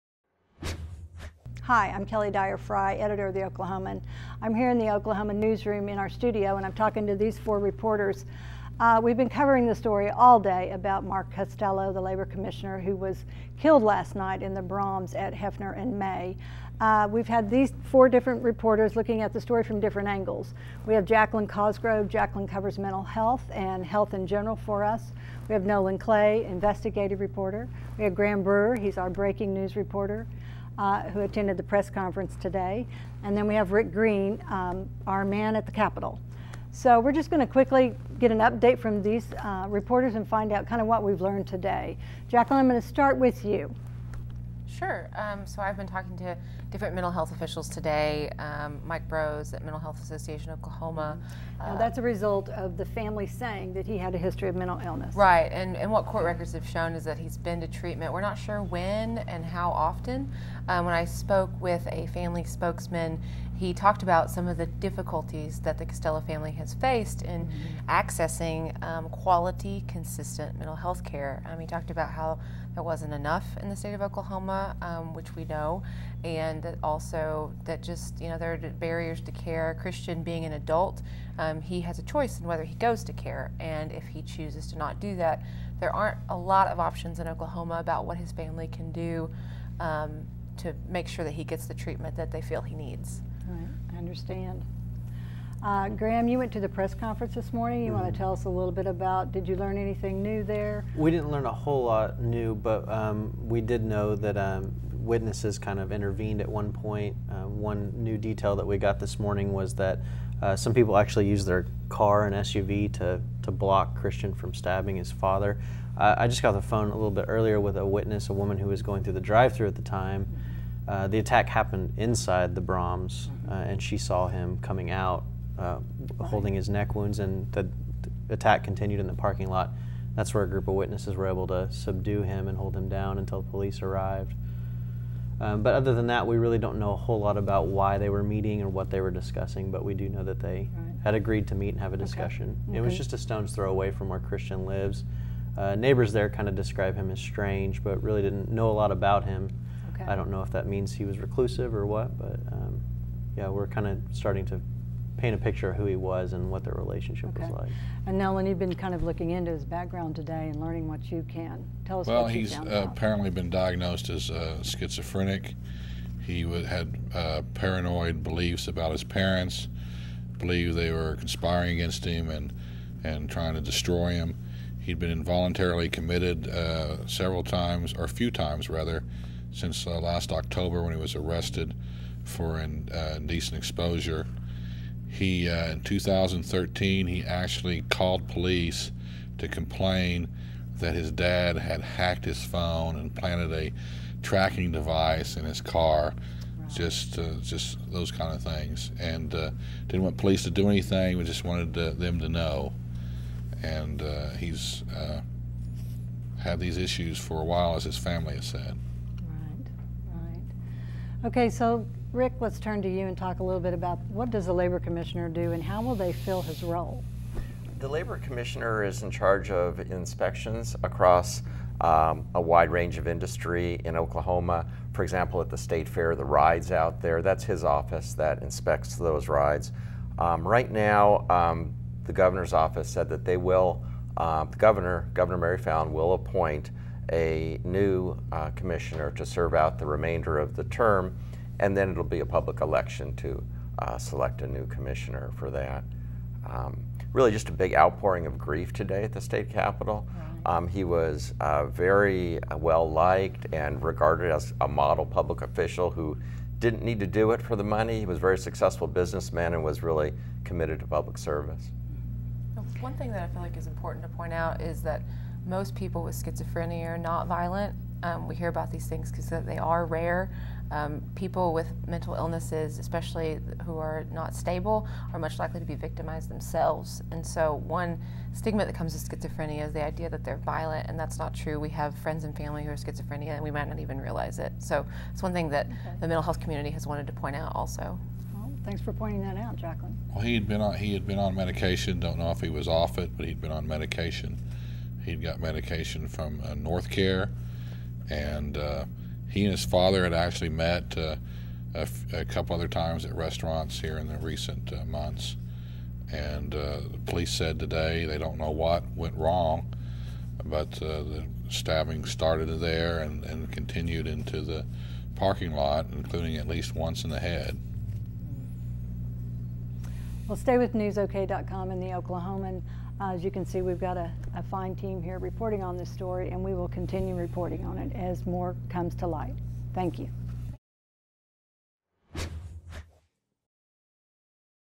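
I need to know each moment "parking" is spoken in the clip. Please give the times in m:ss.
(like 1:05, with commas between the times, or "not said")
2:09, 5:15.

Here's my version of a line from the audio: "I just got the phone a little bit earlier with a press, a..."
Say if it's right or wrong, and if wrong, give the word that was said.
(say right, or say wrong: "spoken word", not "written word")
wrong: "witness", not "press".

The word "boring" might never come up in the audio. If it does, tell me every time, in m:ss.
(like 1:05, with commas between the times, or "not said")
not said.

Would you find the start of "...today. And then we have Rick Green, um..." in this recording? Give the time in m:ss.
0:32.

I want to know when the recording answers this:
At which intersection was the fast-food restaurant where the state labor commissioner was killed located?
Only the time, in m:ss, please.
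0:15.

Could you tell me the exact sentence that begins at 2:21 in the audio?
had agreed to meet and have a discussion.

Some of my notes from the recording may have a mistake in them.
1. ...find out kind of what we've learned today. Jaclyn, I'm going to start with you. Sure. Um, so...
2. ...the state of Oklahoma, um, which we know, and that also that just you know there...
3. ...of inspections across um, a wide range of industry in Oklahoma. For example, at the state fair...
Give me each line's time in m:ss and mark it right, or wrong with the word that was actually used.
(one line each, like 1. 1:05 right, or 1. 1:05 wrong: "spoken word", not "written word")
1. 0:40 right
2. 1:13 right
3. 3:39 right.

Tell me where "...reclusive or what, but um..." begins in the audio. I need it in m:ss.
2:31.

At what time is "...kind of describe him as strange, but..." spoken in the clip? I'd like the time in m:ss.
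2:26.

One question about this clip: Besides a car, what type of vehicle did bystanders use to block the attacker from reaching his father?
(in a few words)
SUV.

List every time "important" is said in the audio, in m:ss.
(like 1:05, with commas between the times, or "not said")
4:23.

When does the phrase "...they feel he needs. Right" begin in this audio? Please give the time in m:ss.
1:32.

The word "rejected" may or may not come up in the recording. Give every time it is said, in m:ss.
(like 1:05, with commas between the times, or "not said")
not said.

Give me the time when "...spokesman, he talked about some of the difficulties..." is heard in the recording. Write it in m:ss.
1:02.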